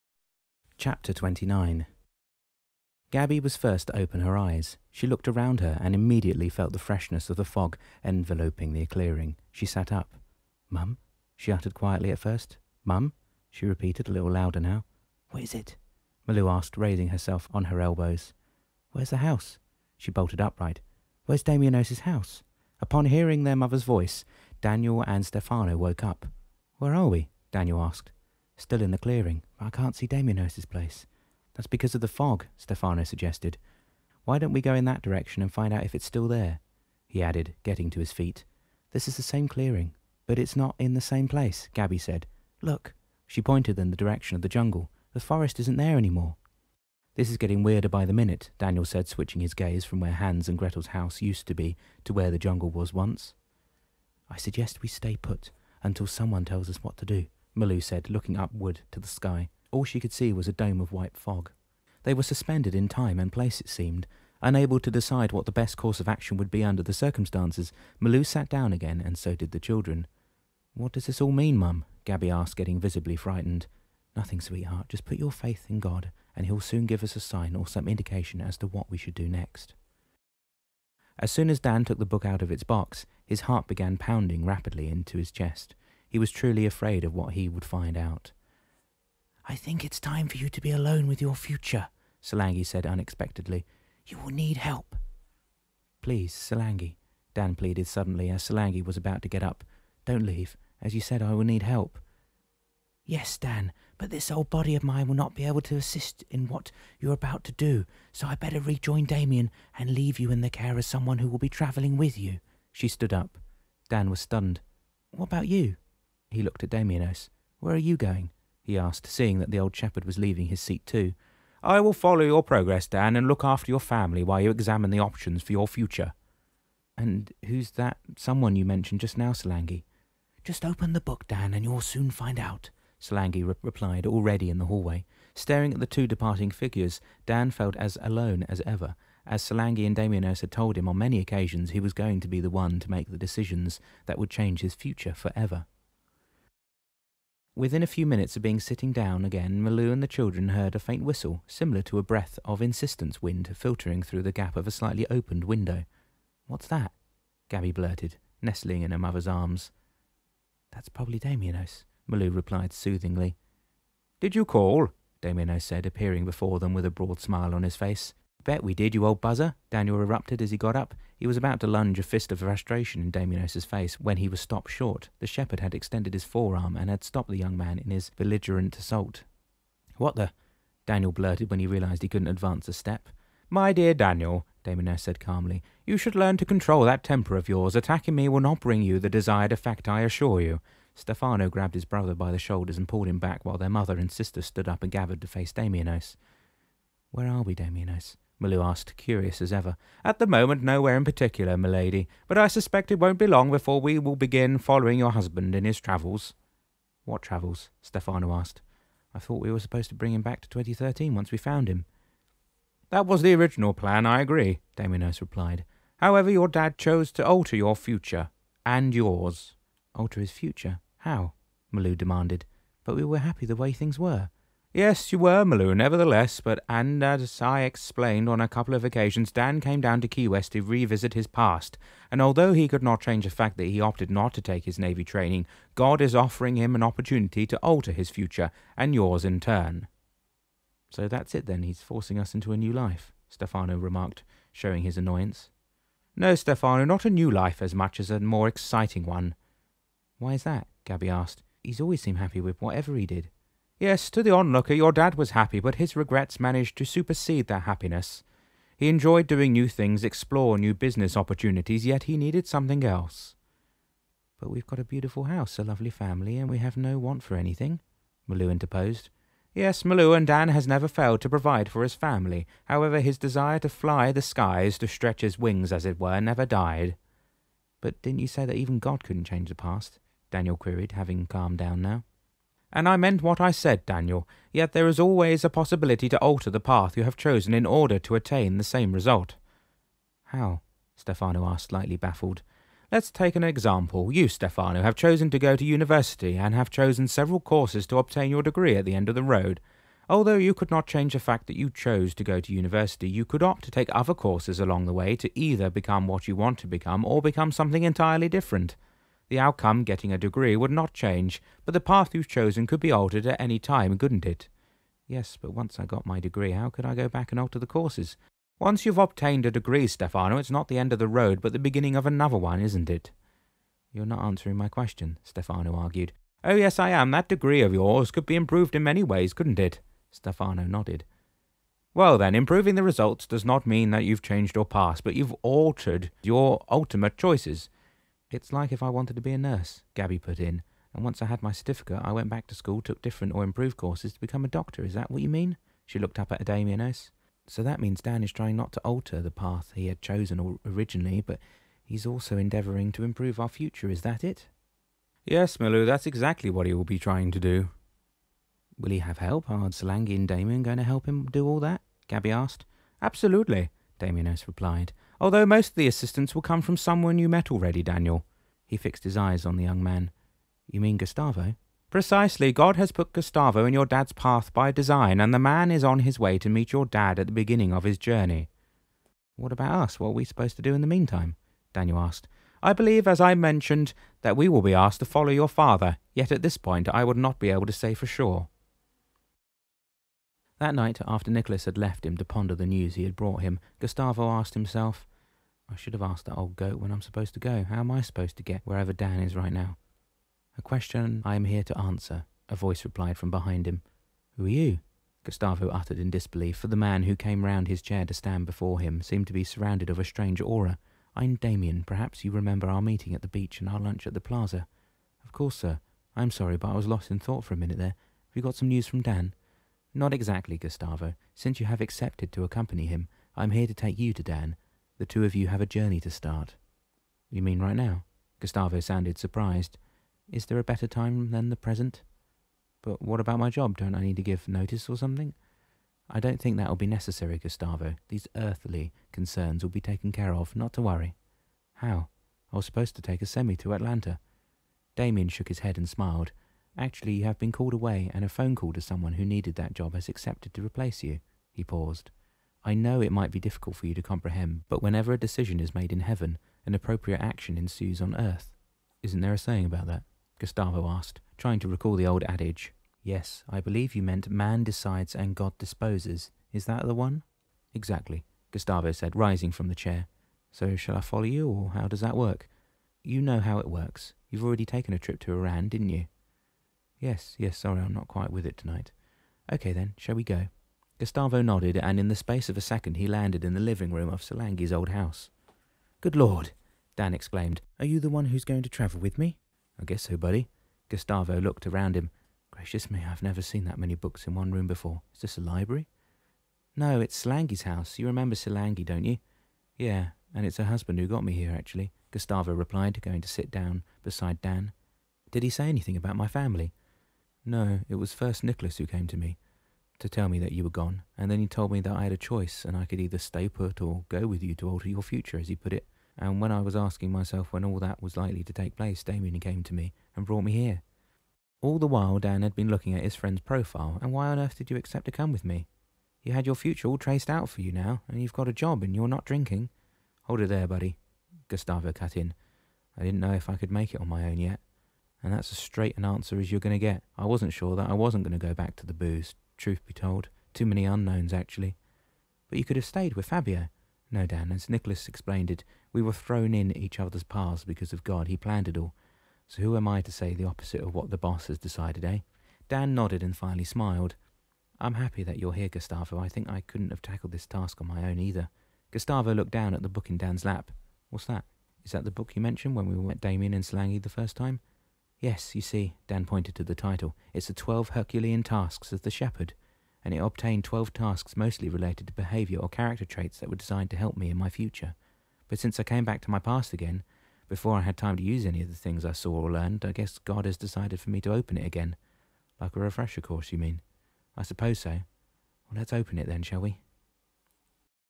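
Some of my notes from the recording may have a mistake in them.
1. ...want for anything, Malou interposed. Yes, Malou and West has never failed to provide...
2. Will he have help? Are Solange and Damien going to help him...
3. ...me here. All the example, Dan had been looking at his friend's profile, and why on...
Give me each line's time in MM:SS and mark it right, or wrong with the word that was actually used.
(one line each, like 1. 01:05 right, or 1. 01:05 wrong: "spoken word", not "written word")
1. 04:26 wrong: "Dan", not "West"
2. 05:58 right
3. 08:40 wrong: "while", not "example".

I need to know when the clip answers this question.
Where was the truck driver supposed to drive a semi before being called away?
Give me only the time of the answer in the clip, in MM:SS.
07:23.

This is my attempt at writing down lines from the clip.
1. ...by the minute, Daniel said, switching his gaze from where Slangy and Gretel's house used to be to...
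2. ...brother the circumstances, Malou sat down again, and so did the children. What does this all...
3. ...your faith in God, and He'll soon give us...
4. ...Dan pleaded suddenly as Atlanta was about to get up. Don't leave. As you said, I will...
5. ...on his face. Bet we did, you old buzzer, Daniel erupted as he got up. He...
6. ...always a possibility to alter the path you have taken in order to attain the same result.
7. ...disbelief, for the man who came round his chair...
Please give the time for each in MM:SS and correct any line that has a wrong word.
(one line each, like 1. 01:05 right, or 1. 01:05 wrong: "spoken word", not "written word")
1. 00:47 wrong: "Hans", not "Slangy"
2. 01:06 wrong: "under", not "brother"
3. 01:15 right
4. 01:37 wrong: "Salangi", not "Atlanta"
5. 02:47 right
6. 04:44 wrong: "chosen", not "taken"
7. 06:46 right.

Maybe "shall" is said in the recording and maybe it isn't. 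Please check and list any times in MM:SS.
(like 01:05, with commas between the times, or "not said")
07:50, 07:59, 09:46.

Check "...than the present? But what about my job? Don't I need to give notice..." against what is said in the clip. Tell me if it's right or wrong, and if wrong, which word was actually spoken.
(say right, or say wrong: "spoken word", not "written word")
right.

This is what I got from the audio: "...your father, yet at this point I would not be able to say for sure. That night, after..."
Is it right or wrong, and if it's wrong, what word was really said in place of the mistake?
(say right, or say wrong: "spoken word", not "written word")
right.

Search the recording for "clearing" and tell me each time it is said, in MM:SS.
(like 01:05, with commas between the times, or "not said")
00:08, 00:28, 00:39.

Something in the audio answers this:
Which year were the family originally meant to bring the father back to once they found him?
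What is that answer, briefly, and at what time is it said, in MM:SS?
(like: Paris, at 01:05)
2013, at 03:30.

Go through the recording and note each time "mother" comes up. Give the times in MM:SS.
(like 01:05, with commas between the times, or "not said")
00:23, 02:38, 03:13.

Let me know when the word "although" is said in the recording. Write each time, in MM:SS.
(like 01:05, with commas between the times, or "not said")
03:52, 05:00, 06:05.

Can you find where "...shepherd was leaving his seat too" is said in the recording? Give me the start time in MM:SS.
01:59.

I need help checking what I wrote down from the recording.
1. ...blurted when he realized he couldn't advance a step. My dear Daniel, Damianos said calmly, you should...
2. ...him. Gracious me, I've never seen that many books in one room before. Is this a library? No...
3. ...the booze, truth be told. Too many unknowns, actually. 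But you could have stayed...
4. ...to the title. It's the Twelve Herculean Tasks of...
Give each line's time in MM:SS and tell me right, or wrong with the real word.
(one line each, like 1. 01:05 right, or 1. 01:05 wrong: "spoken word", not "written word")
1. 03:01 right
2. 08:11 right
3. 08:58 right
4. 09:26 right.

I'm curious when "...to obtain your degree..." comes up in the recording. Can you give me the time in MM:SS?
04:57.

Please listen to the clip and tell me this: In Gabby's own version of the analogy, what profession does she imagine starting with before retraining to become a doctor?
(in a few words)
nurse.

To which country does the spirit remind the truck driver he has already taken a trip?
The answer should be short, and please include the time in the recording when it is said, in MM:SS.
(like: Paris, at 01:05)
Iran, at 07:55.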